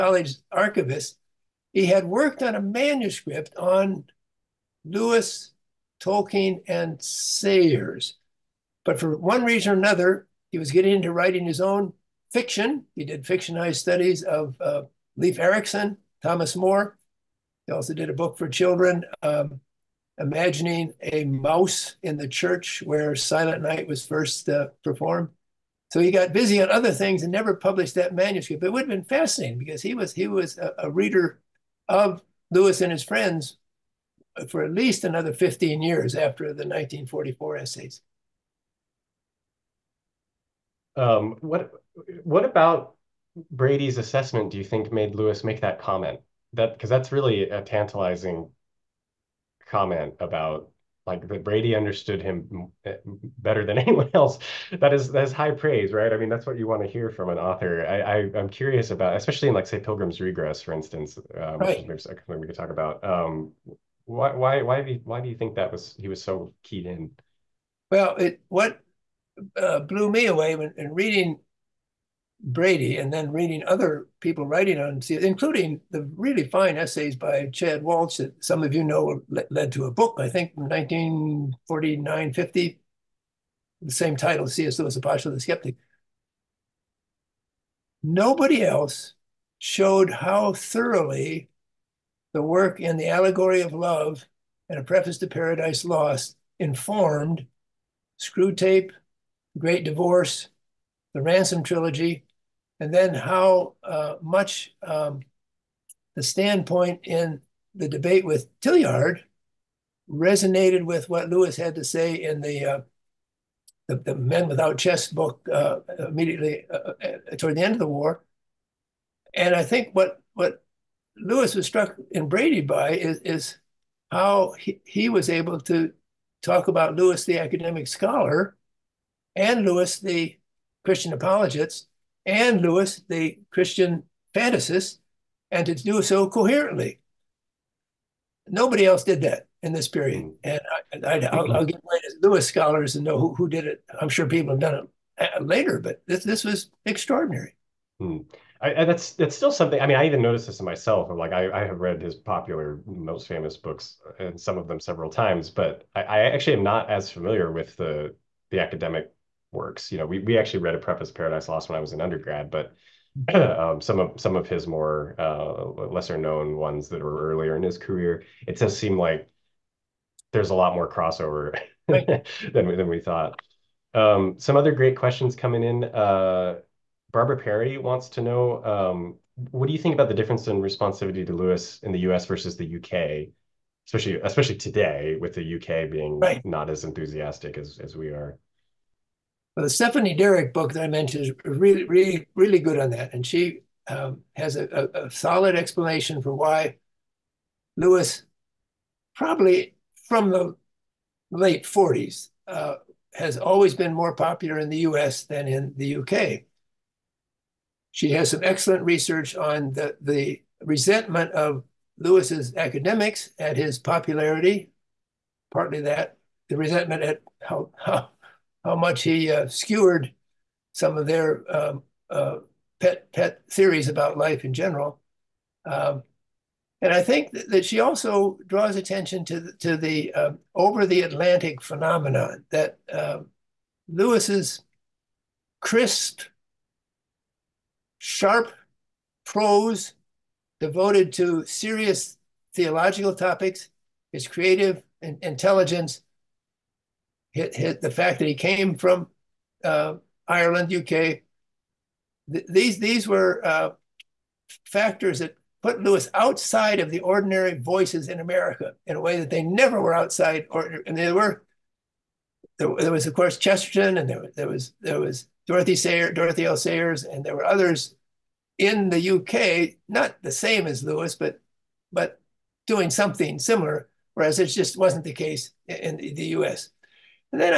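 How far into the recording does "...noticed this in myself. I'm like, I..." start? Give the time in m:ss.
2:30.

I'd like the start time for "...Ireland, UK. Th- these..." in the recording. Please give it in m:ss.
4:10.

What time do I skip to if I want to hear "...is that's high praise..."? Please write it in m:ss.
0:54.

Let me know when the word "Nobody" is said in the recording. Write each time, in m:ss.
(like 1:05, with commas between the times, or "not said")
1:28, 2:18.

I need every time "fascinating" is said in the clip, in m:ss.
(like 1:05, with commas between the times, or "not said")
0:29.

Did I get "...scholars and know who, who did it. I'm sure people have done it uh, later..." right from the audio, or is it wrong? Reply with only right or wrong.
right.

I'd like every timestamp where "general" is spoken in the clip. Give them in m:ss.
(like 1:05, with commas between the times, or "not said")
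3:44.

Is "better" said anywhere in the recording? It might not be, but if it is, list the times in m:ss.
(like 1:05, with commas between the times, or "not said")
0:53.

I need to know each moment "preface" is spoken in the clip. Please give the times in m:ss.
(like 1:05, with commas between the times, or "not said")
1:34, 2:40.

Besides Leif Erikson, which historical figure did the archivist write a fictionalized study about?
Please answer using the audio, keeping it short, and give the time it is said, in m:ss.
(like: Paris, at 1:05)
Thomas More, at 0:16.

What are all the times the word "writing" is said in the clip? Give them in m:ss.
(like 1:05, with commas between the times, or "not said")
0:11, 1:14.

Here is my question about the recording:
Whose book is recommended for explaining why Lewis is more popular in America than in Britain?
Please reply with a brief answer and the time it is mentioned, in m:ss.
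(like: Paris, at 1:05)
Stephanie Derrick, at 3:09.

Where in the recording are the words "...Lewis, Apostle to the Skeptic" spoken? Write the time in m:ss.
1:24.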